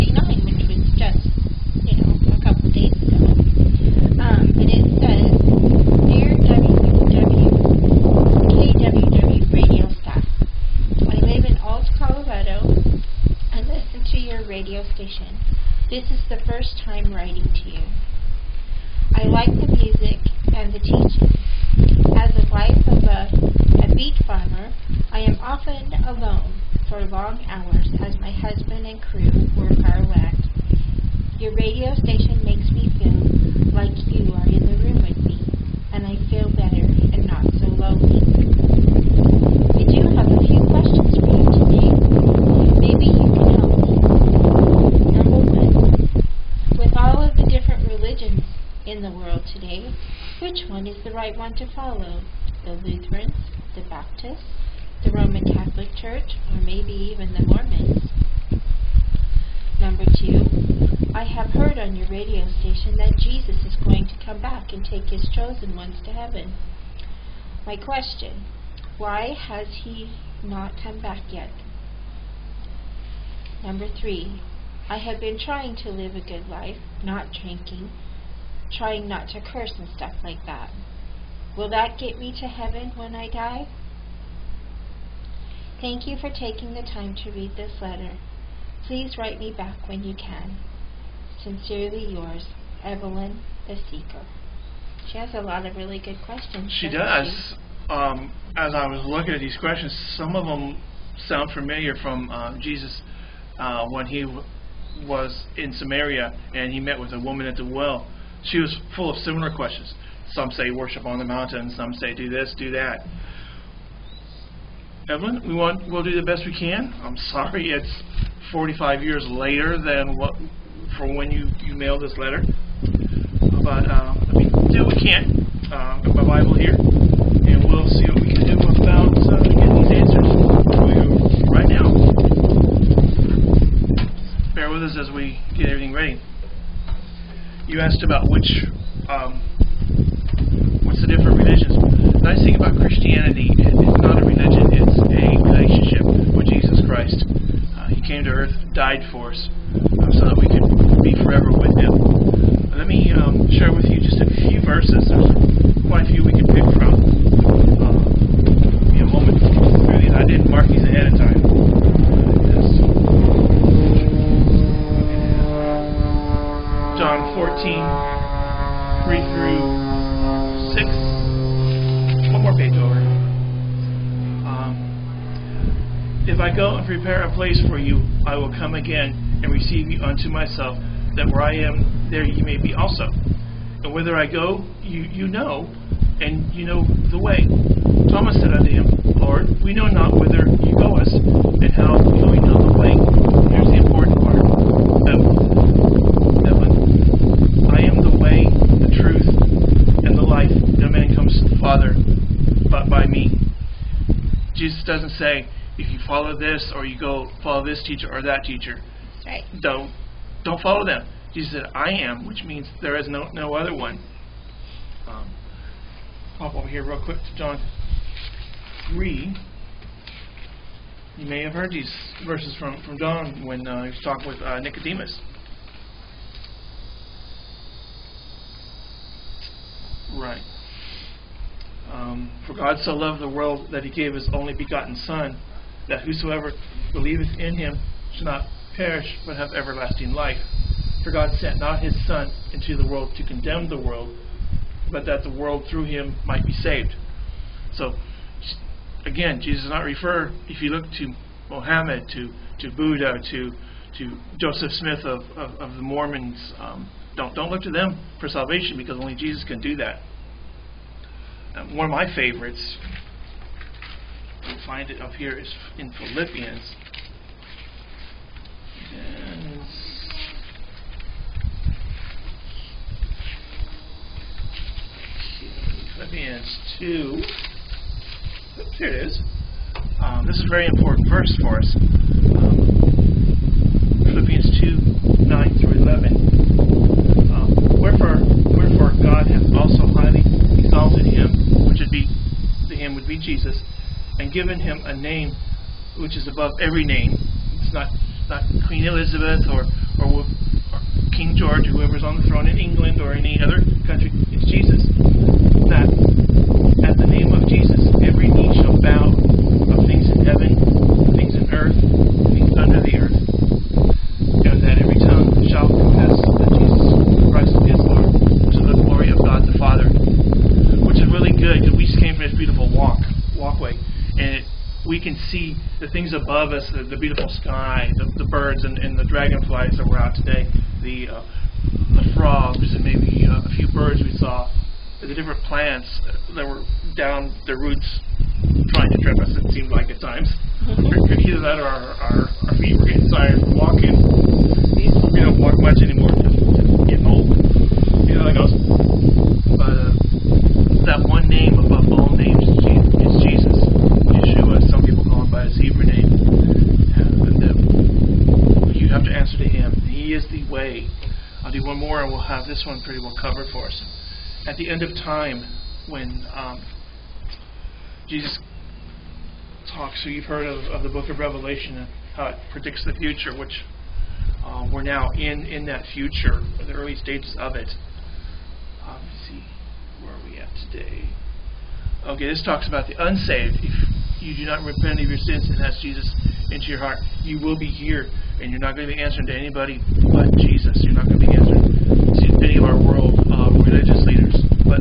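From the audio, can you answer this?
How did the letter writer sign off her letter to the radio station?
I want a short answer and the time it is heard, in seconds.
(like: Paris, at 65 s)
Evelyn the Seeker, at 92 s.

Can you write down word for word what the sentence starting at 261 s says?
Um, one of my favorites find it up here is in Philippians.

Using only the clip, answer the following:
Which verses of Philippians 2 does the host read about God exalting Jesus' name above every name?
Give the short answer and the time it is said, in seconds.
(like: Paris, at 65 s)
9 through 11, at 285 s.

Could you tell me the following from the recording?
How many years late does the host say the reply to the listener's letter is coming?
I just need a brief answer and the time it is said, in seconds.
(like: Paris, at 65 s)
45, at 118 s.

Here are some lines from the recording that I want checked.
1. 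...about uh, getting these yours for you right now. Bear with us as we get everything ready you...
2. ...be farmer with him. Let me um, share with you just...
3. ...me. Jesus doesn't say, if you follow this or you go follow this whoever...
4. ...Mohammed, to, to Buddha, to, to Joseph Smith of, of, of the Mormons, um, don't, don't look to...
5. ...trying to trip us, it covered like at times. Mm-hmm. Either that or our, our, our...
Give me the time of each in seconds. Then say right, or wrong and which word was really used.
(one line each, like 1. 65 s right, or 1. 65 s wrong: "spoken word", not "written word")
1. 128 s wrong: "answers", not "yours"
2. 151 s wrong: "forever", not "farmer"
3. 203 s wrong: "teacher", not "whoever"
4. 251 s right
5. 338 s wrong: "seemed", not "covered".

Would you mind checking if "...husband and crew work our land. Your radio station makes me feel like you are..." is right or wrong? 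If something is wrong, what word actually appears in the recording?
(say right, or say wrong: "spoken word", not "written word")
right.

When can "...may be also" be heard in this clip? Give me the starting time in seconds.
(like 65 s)
182 s.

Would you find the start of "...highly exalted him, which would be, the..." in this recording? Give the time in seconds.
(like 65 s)
289 s.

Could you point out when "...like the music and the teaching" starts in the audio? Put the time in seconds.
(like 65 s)
19 s.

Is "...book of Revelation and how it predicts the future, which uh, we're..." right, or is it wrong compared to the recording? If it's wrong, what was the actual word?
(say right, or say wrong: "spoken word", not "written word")
right.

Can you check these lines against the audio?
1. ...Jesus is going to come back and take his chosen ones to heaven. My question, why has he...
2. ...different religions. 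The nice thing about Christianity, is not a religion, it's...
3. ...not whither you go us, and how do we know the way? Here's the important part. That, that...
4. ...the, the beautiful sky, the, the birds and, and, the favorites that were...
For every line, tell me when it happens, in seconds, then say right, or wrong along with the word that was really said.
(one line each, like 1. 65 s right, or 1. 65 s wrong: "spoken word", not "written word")
1. 63 s right
2. 141 s right
3. 189 s right
4. 326 s wrong: "dragonflies", not "favorites".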